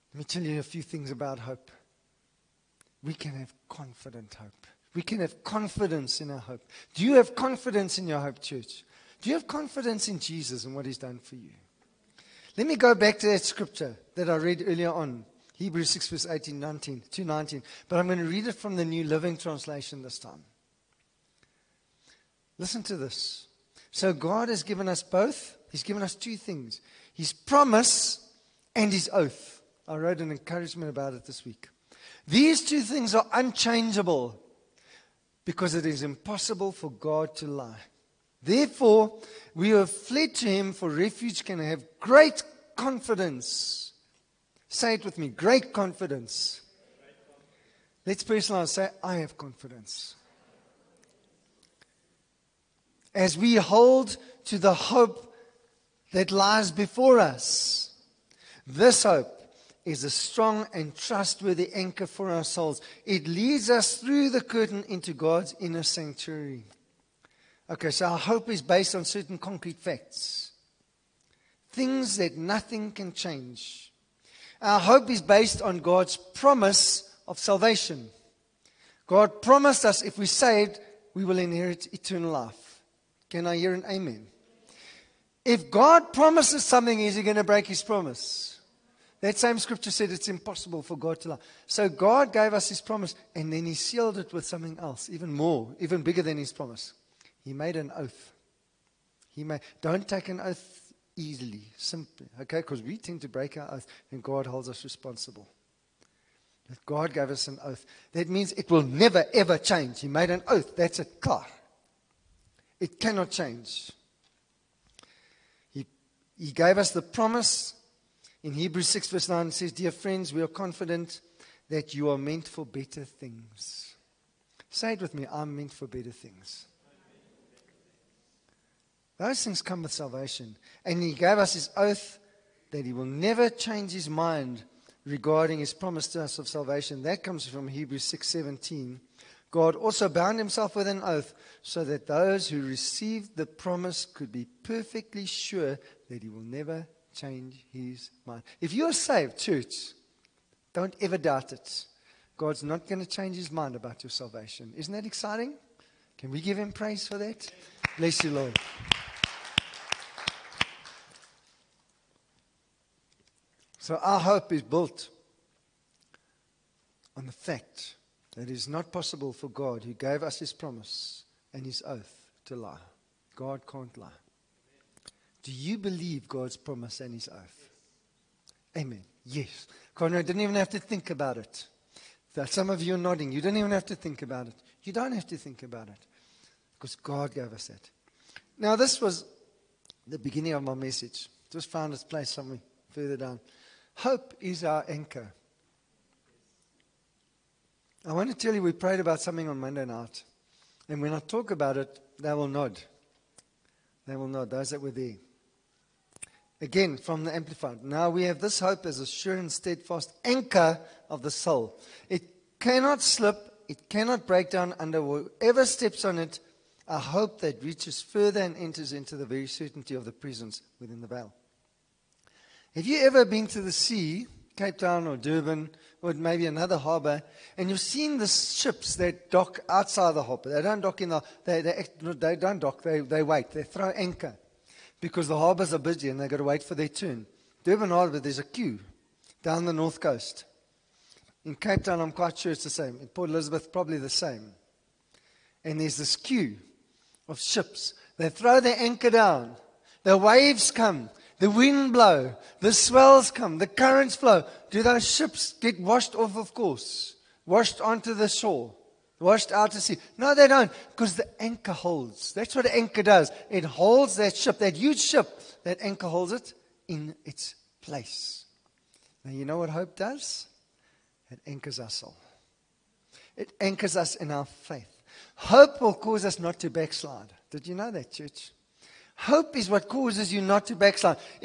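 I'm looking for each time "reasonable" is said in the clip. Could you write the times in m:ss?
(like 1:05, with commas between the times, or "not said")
not said.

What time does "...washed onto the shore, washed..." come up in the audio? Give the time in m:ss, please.
4:17.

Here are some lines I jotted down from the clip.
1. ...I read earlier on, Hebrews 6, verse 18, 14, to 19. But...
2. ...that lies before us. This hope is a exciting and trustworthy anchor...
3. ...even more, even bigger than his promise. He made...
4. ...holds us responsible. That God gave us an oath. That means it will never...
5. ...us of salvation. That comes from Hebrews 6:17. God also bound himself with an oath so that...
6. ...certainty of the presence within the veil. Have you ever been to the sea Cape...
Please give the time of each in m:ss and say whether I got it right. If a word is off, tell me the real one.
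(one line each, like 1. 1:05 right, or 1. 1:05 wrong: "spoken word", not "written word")
1. 0:14 wrong: "19", not "14"
2. 0:56 wrong: "strong", not "exciting"
3. 1:35 right
4. 1:44 right
5. 2:16 right
6. 3:39 right.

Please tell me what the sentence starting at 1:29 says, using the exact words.
That same scripture said it's impossible for God to lie.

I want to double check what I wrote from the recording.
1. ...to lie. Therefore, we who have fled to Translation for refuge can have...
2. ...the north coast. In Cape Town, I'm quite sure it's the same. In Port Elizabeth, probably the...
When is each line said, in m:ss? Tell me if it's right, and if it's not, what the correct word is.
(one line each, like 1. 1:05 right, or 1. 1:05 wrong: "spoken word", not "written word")
1. 0:37 wrong: "Him", not "Translation"
2. 3:59 right.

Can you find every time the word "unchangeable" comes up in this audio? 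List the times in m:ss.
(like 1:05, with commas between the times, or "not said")
0:33.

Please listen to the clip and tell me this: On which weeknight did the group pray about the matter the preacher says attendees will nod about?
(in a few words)
Monday.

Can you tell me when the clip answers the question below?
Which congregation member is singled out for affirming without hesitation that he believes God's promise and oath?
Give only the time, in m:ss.
2:59.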